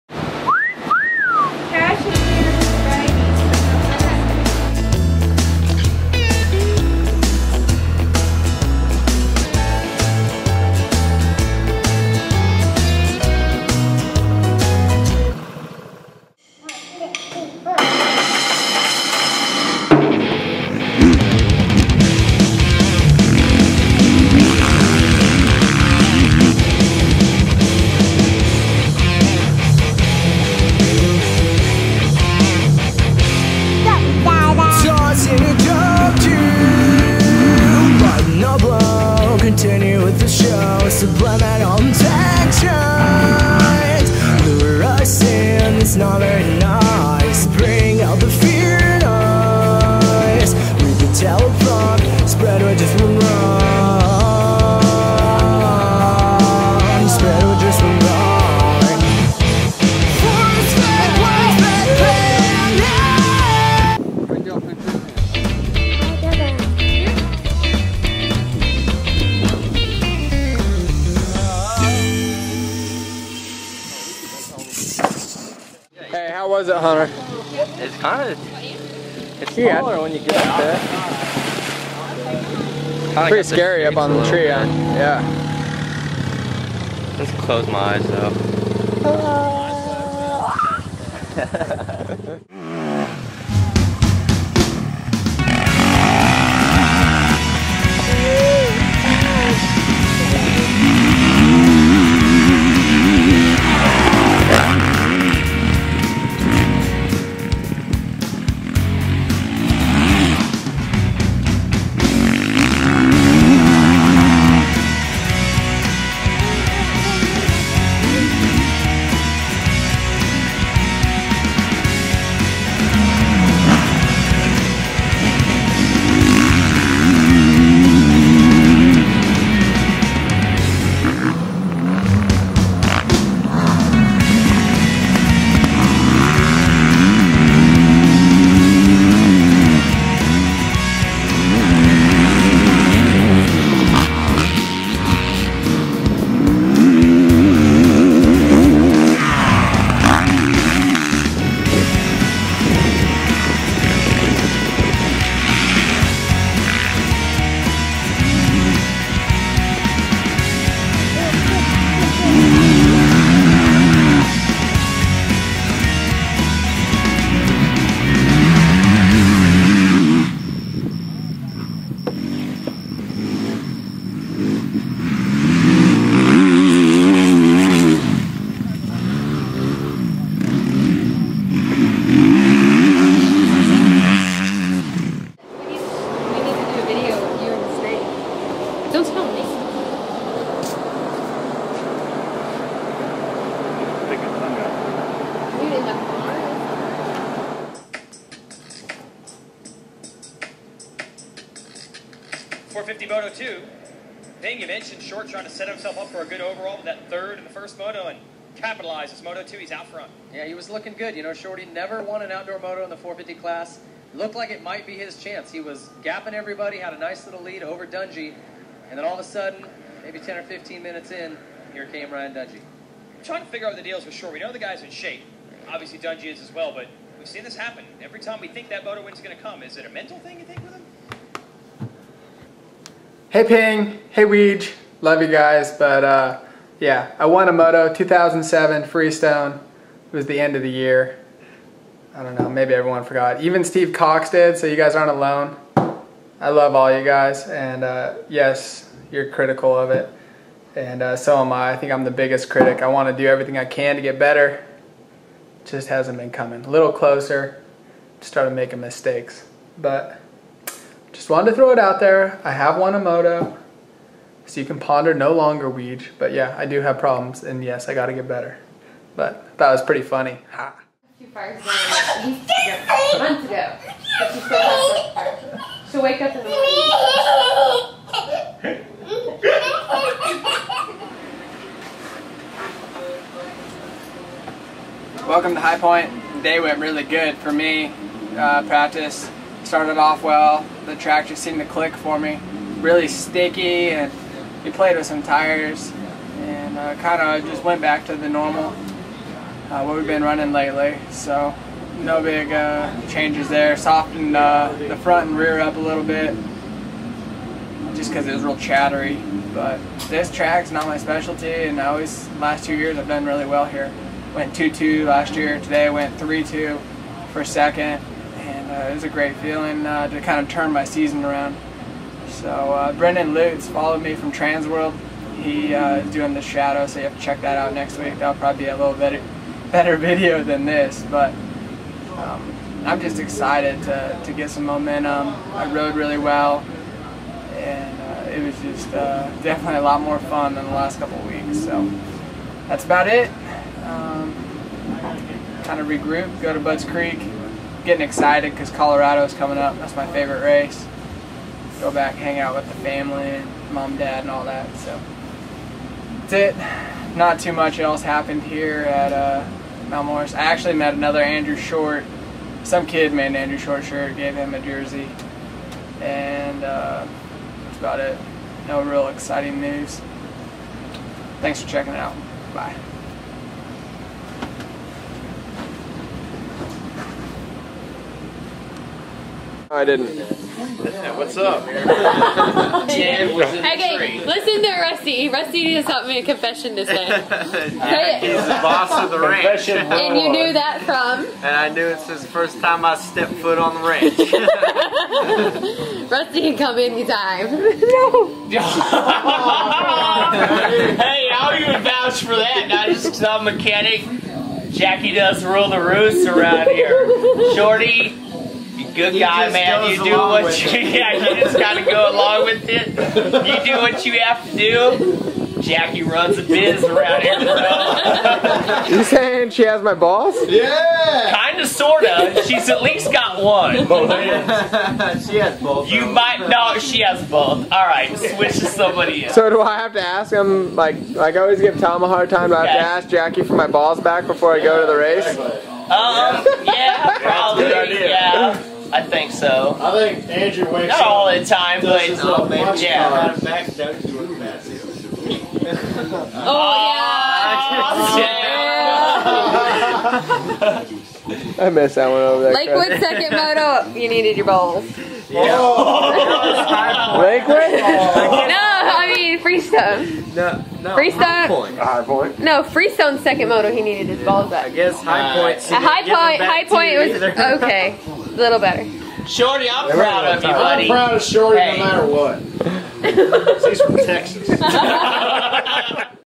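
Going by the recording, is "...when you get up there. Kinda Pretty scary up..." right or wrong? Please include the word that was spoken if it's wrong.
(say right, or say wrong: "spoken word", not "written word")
right.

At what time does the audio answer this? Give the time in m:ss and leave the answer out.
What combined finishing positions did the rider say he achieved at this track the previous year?
5:14.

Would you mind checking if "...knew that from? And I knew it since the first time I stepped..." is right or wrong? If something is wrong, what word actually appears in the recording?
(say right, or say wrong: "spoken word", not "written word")
right.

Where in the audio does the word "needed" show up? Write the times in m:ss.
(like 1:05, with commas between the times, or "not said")
7:34, 7:43.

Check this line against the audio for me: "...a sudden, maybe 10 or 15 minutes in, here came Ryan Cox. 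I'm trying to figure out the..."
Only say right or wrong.
wrong.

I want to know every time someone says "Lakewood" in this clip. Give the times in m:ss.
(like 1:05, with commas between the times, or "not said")
7:32, 7:37.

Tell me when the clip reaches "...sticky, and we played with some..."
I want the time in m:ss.
4:53.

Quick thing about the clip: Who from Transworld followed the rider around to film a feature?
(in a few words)
Brendan Lutes.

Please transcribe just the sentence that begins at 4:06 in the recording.
I love all you guys, and uh, yes, you're critical of it, and uh, so am I.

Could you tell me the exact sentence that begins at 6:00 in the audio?
I actually met another Andrew Short.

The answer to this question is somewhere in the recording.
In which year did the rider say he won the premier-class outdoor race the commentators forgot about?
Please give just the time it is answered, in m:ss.
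3:57.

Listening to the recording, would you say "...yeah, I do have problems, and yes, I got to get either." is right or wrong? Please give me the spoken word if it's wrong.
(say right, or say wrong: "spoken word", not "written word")
wrong: "better", not "either".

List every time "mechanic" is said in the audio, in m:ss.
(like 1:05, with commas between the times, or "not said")
6:43.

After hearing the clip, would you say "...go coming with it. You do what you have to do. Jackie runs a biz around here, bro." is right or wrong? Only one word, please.
wrong.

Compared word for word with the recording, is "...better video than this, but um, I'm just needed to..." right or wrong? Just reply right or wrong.
wrong.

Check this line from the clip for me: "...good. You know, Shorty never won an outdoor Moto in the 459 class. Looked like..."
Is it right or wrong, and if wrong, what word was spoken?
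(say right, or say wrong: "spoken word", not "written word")
wrong: "450", not "459".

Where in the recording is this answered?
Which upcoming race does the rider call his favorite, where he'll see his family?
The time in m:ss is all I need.
5:48.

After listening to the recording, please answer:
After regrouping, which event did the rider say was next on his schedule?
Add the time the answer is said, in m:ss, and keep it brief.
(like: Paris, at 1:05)
Budds Creek, at 5:46.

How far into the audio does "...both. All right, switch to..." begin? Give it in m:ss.
7:07.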